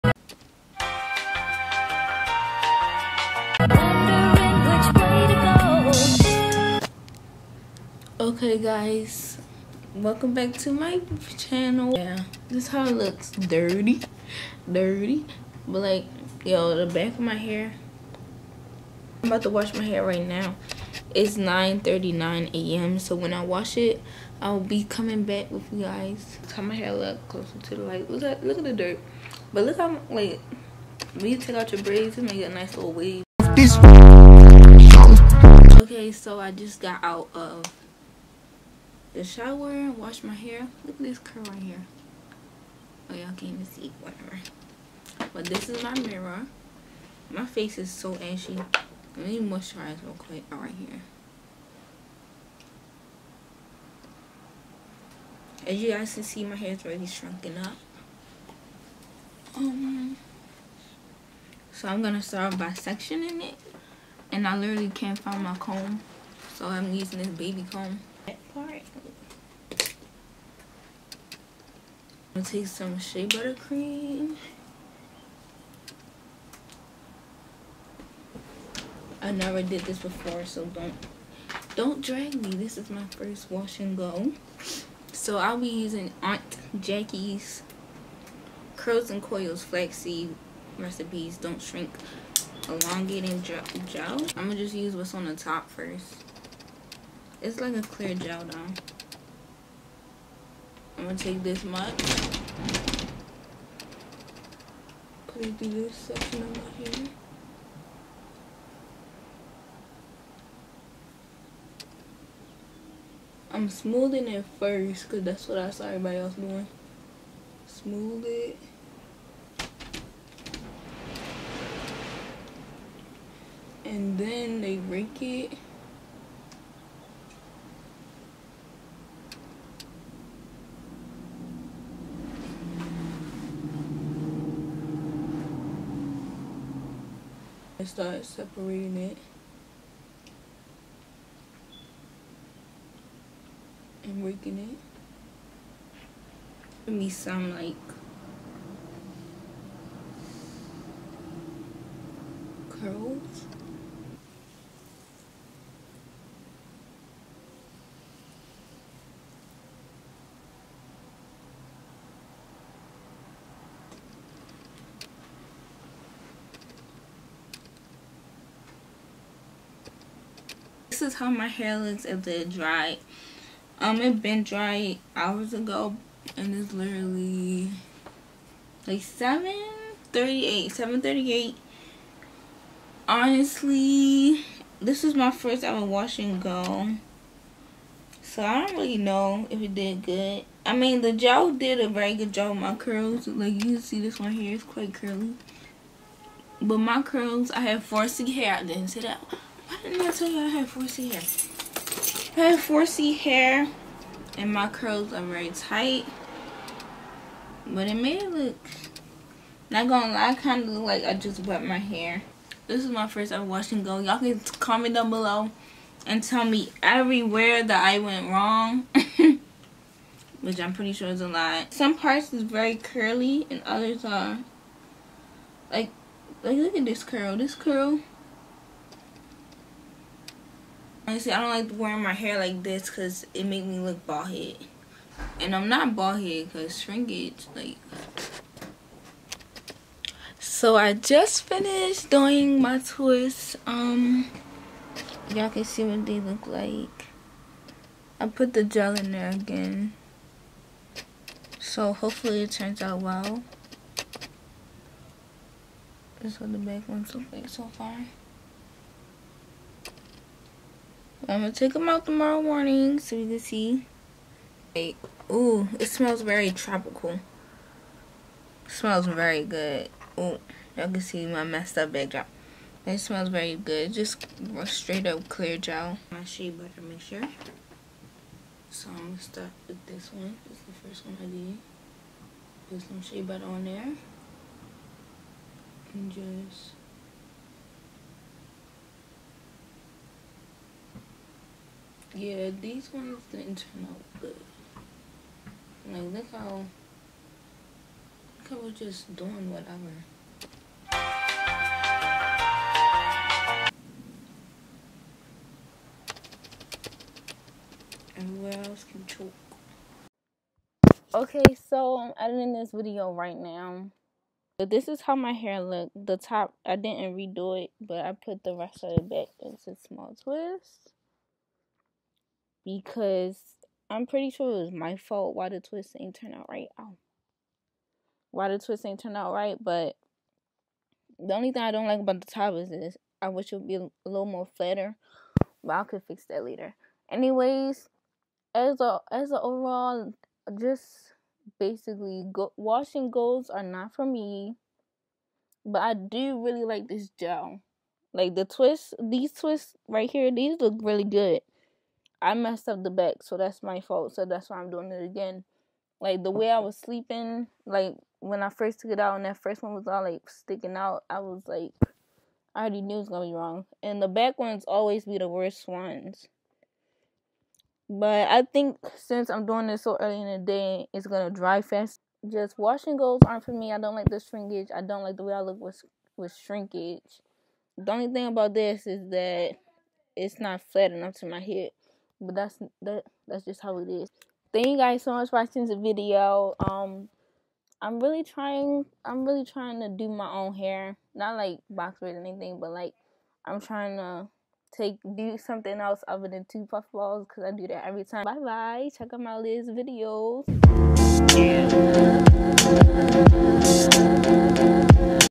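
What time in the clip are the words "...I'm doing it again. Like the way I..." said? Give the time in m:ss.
5:54.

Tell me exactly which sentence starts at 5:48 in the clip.
Like the twist, these twists right here, these look really good.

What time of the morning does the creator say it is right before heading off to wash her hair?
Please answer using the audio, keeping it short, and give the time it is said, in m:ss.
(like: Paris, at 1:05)
9:39 a.m., at 0:21.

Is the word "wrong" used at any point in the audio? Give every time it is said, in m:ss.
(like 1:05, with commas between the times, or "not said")
3:38, 6:03.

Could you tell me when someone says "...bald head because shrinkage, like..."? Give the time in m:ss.
3:55.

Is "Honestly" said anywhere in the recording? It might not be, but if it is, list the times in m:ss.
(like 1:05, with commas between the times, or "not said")
3:03, 3:51.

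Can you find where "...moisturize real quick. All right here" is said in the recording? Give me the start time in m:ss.
0:49.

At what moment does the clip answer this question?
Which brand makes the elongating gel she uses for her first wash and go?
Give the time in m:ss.
1:26.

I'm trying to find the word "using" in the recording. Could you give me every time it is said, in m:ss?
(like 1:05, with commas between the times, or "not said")
1:06, 1:25.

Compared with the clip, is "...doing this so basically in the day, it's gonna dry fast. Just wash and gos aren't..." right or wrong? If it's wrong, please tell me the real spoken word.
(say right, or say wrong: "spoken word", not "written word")
wrong: "early", not "basically".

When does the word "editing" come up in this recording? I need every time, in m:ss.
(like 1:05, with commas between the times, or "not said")
5:12.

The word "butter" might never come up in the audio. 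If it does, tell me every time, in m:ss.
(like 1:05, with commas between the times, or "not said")
1:13, 4:36, 4:43.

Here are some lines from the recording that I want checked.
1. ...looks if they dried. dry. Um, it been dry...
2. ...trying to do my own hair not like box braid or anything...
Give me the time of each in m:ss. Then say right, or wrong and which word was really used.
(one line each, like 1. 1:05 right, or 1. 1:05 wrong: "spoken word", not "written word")
1. 2:51 right
2. 6:29 right.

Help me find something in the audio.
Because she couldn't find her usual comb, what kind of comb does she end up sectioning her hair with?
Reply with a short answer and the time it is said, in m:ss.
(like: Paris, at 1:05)
baby comb, at 1:07.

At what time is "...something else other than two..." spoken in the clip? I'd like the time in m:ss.
6:35.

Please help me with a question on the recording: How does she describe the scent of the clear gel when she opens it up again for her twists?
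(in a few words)
tropical.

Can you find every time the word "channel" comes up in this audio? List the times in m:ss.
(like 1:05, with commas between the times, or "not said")
0:11.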